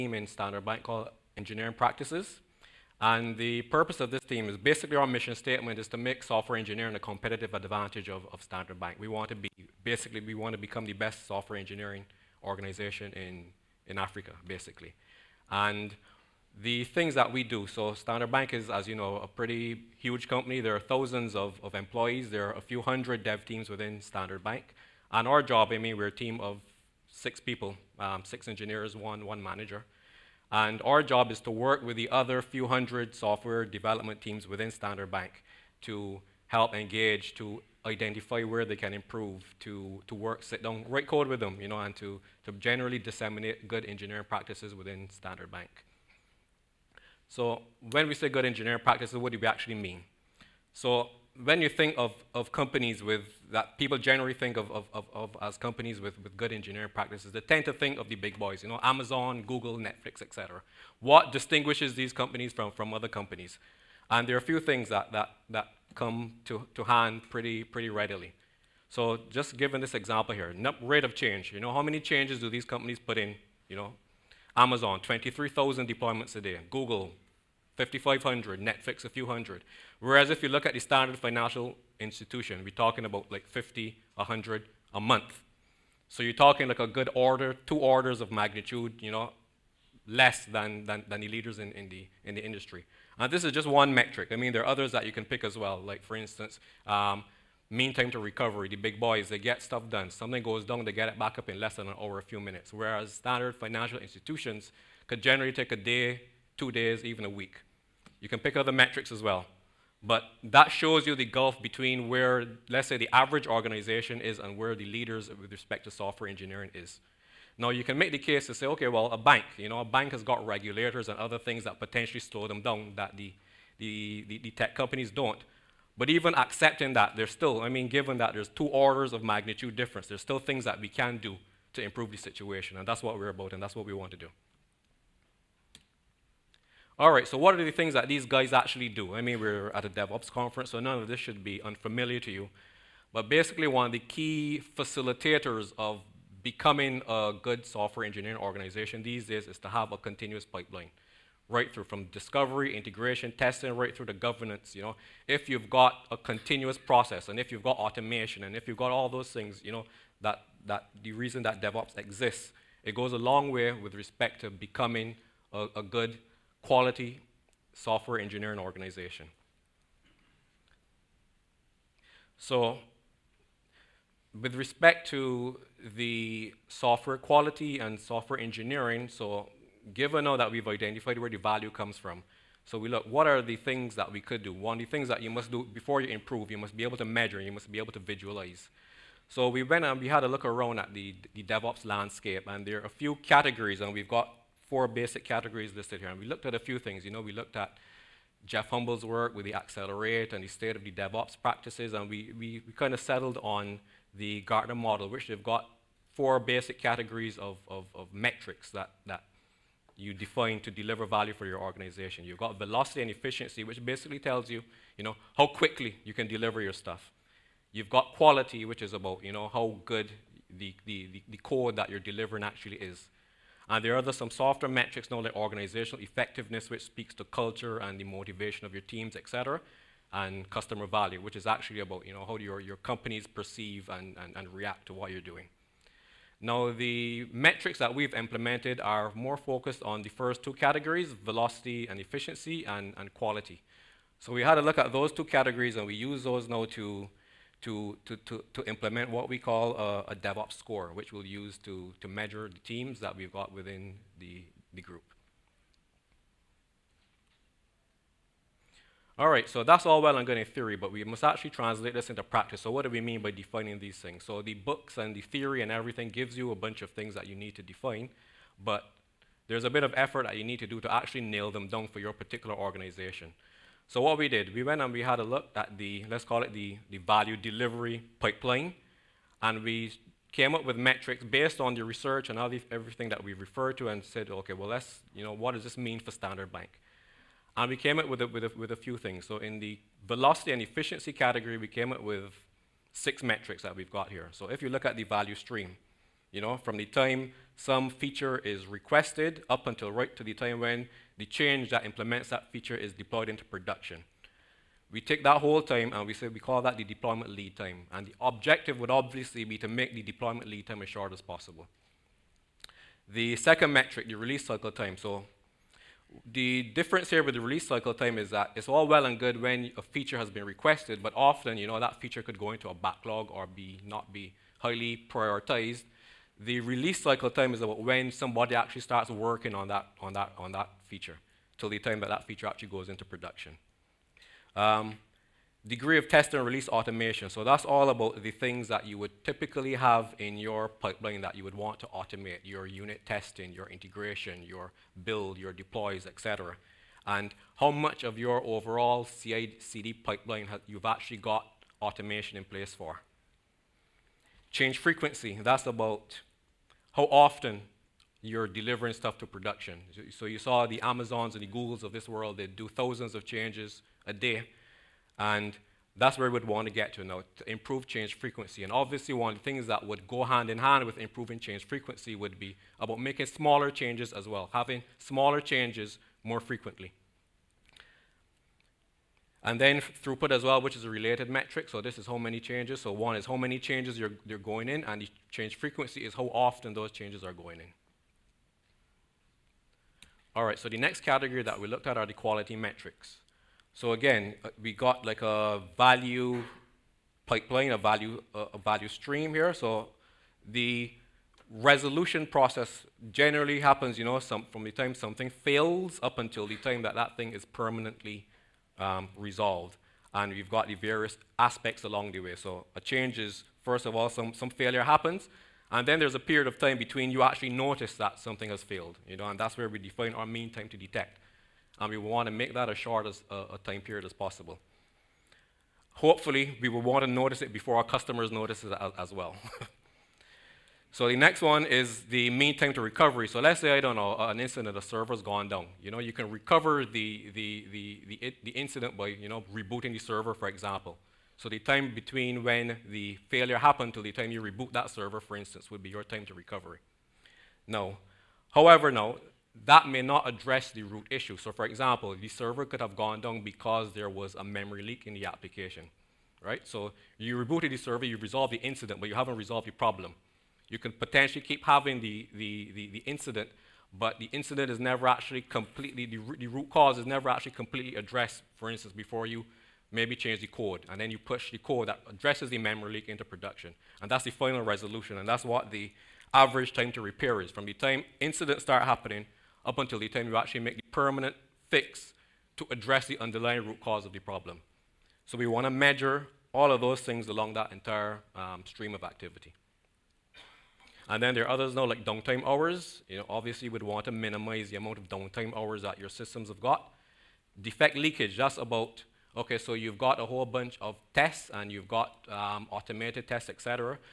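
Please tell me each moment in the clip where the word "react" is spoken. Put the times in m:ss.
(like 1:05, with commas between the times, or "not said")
3:54.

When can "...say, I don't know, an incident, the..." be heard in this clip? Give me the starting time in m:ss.
7:13.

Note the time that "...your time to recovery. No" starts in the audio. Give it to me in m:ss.
7:25.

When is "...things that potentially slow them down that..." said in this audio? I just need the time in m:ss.
2:01.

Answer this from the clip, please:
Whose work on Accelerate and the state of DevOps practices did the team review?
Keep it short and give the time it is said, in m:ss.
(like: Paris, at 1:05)
Jez Humble, at 3:18.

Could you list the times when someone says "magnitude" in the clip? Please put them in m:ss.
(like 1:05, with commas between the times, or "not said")
1:28, 2:09.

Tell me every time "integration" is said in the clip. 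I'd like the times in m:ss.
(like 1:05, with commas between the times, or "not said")
2:32, 5:43.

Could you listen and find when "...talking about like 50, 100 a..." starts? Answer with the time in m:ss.
1:22.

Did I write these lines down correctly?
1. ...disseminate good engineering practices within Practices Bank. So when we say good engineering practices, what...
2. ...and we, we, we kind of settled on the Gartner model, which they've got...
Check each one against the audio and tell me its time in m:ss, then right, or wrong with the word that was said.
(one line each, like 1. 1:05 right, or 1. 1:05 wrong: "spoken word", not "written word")
1. 0:42 wrong: "Standard", not "Practices"
2. 3:21 right.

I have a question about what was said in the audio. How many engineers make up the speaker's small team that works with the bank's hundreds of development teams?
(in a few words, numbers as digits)
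6.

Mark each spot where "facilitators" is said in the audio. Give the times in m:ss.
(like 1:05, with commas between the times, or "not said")
2:24.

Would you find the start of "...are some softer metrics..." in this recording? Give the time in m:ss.
3:43.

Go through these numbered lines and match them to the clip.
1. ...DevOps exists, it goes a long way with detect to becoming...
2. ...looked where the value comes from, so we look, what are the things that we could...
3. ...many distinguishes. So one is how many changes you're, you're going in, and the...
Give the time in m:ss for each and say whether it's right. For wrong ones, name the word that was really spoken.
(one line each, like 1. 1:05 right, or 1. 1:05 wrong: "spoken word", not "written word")
1. 2:41 wrong: "respect", not "detect"
2. 3:00 wrong: "identified", not "looked"
3. 6:22 wrong: "changes", not "distinguishes".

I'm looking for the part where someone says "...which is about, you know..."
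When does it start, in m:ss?
3:38.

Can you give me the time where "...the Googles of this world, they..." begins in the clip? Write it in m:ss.
6:01.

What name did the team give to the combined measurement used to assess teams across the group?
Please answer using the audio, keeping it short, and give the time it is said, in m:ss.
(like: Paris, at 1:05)
DevOps score, at 4:10.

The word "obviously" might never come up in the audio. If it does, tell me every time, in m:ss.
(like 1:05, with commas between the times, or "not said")
5:08, 6:08, 8:13.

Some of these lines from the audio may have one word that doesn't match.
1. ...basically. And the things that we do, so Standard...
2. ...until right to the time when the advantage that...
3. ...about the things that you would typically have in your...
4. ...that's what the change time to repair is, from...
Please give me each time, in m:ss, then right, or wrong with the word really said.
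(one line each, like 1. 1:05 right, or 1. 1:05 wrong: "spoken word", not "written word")
1. 0:14 right
2. 4:59 wrong: "change", not "advantage"
3. 5:37 right
4. 7:55 wrong: "average", not "change".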